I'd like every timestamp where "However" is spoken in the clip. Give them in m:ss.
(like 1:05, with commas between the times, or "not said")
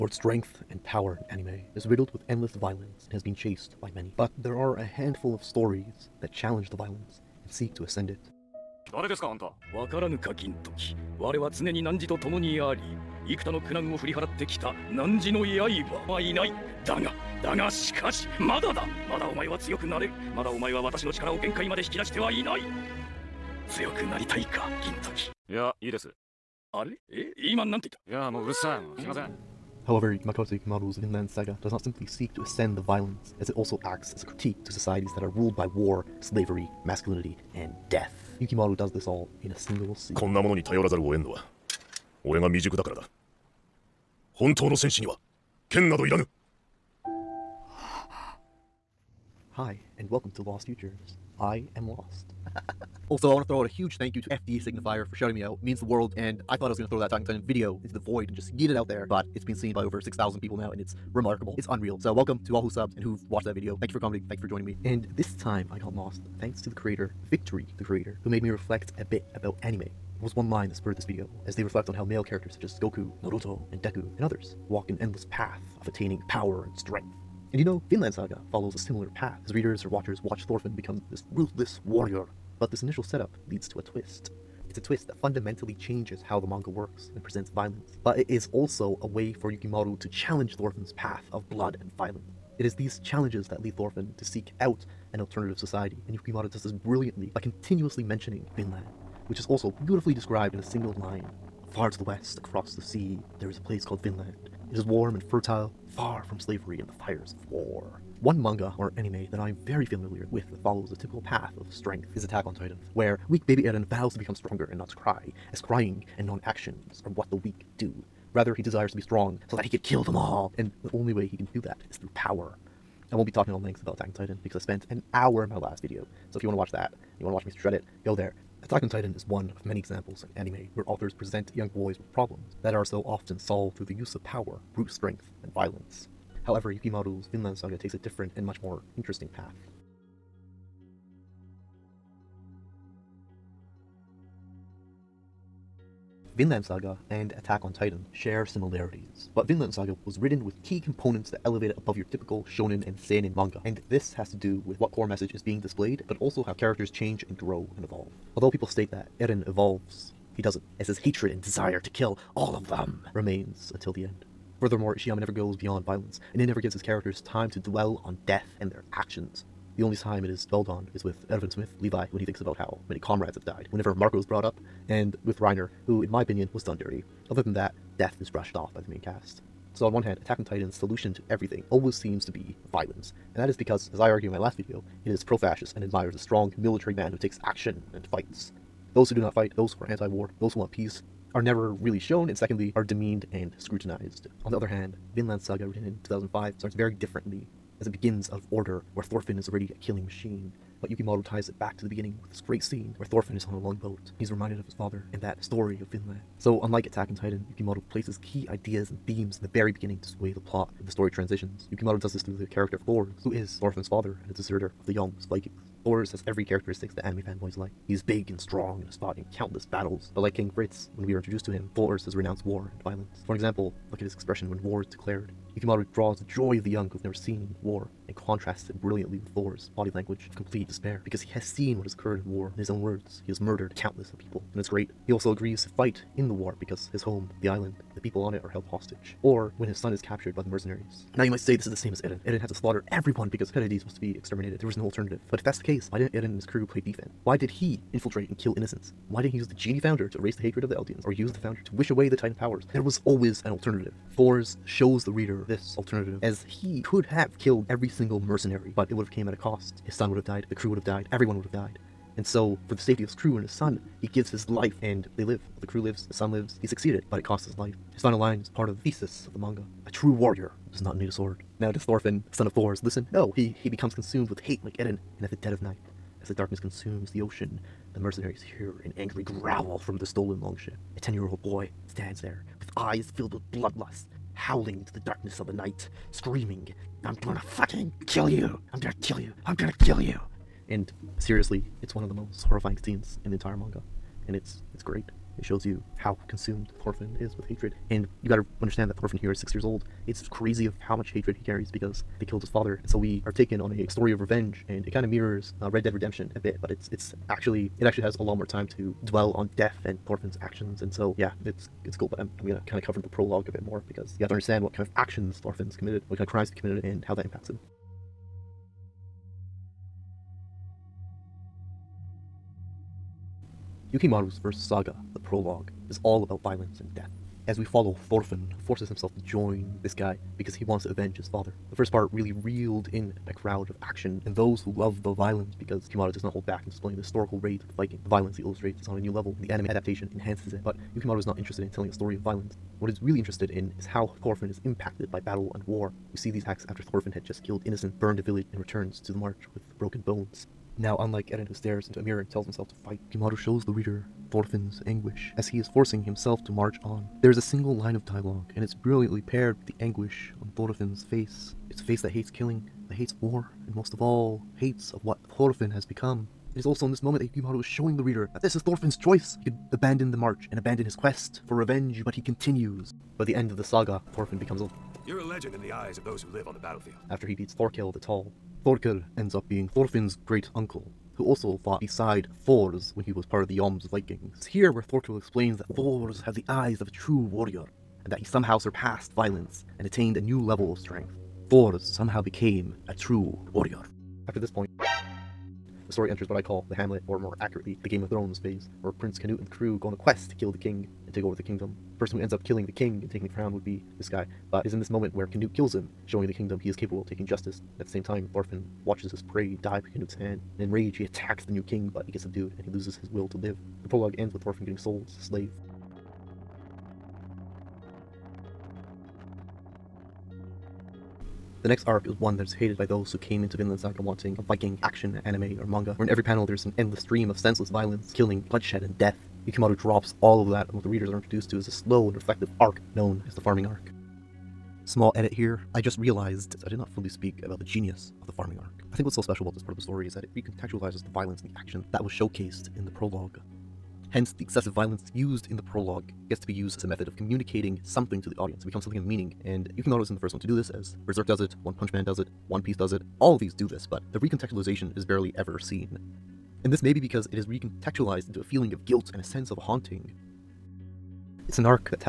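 0:29, 2:16.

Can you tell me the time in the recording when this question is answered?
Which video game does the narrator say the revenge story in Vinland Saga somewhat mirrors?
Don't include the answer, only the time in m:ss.
5:05.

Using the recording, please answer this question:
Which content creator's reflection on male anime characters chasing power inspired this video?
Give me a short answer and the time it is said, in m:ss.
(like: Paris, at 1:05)
Victory, at 1:07.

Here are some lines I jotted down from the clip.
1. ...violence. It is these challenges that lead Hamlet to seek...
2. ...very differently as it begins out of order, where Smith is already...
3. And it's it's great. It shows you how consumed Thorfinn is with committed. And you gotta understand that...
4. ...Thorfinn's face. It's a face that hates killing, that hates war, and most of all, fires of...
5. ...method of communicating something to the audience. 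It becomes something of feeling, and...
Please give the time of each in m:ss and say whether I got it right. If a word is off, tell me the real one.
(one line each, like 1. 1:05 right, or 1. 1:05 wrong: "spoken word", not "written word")
1. 1:31 wrong: "Thorfinn", not "Hamlet"
2. 3:16 wrong: "Thorfinn", not "Smith"
3. 4:54 wrong: "hatred", not "committed"
4. 6:00 wrong: "hates", not "fires"
5. 7:26 wrong: "meaning", not "feeling".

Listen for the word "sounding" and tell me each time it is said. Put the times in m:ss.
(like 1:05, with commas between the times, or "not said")
not said.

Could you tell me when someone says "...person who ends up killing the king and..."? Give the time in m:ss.
6:41.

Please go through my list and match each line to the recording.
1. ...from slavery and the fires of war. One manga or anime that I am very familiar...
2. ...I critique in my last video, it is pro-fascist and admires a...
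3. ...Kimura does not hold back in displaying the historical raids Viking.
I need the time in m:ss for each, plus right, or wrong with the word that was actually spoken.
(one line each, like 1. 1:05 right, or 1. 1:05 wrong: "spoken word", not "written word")
1. 1:46 right
2. 3:03 wrong: "argue", not "critique"
3. 5:35 right.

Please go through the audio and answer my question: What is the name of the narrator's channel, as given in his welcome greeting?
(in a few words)
Lost Futures.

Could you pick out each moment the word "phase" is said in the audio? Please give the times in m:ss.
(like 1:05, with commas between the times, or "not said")
6:38.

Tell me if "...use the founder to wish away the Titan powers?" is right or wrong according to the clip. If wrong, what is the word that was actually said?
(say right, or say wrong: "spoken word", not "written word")
right.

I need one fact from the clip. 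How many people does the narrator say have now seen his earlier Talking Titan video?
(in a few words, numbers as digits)
6,000.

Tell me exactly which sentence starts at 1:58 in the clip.
Rather, he desires to be strong so that he could kill them all.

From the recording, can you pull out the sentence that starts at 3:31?
Yukimoto does this through the character of Thor, who is Thorfinn's father and a deserter of the young Vikings.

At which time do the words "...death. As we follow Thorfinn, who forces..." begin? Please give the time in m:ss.
5:26.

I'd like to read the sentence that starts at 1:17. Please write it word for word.
And you know, Vinland Saga follows a similar path as readers or watchers watch Thorfinn become this ruthless warrior.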